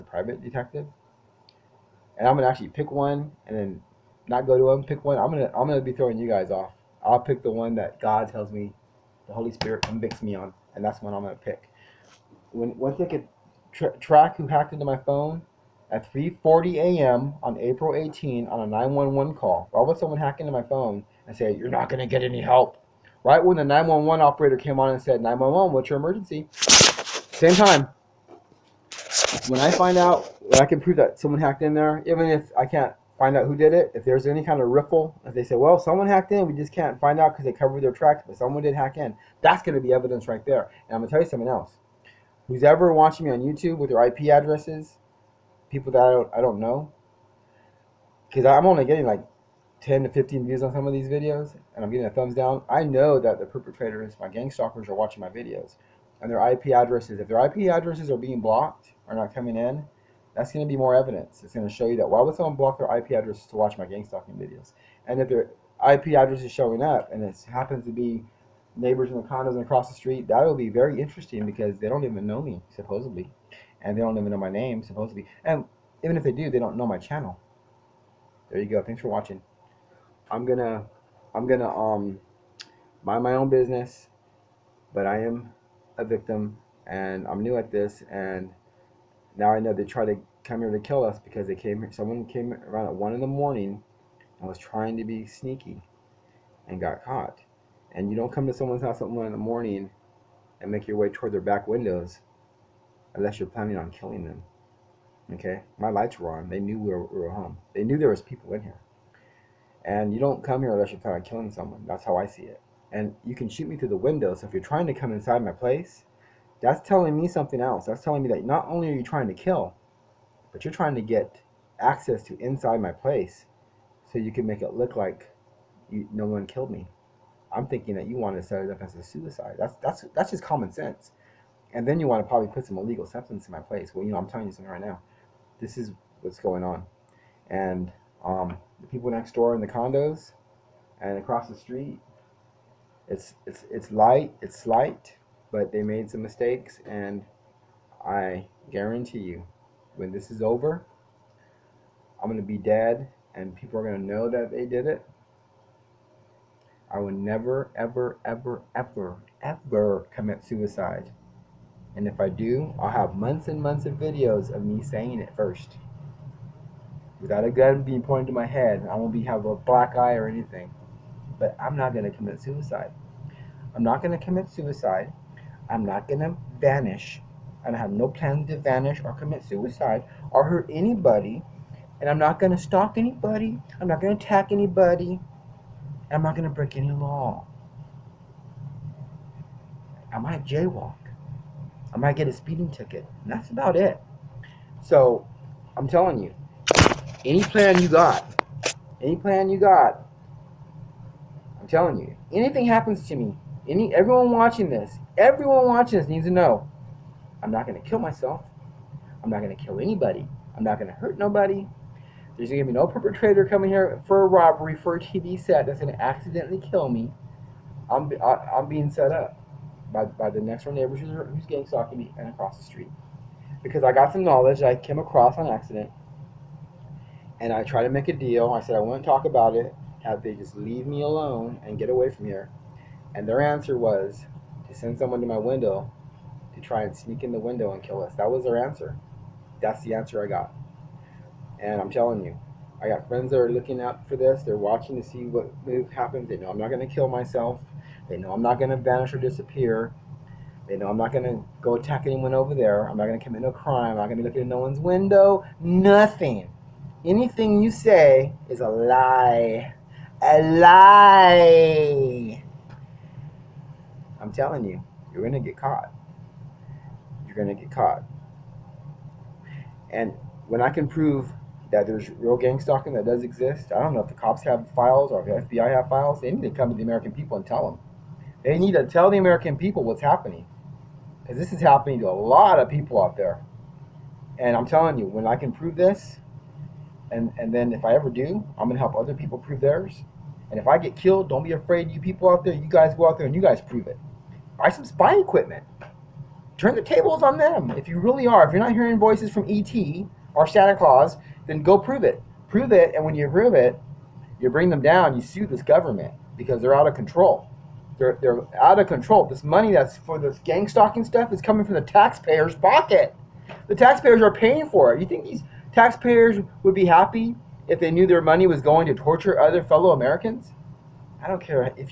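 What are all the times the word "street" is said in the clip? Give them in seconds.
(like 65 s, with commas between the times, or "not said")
69 s, 141 s, 222 s.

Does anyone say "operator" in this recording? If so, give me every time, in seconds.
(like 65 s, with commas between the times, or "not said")
24 s.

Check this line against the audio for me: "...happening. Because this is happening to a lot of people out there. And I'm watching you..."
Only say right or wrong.
wrong.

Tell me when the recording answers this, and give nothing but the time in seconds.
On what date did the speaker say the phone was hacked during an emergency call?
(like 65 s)
17 s.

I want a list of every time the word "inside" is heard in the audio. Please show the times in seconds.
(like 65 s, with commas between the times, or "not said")
115 s, 122 s.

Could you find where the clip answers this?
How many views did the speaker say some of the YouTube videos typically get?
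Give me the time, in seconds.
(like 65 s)
49 s.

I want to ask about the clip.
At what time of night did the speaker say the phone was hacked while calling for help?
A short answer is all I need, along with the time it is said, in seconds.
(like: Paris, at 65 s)
3:40 a.m., at 16 s.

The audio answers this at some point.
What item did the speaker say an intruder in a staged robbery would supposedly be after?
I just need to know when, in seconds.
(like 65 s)
214 s.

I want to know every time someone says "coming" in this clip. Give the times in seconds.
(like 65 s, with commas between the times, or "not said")
59 s, 213 s, 311 s.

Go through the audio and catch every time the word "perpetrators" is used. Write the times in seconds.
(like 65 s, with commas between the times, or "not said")
53 s, 212 s.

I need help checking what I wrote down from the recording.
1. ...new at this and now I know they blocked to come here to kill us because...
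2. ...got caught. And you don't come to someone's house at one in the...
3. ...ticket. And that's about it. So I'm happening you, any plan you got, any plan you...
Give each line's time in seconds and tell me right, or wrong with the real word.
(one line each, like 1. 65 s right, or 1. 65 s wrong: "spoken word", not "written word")
1. 87 s wrong: "tried", not "blocked"
2. 96 s right
3. 192 s wrong: "telling", not "happening".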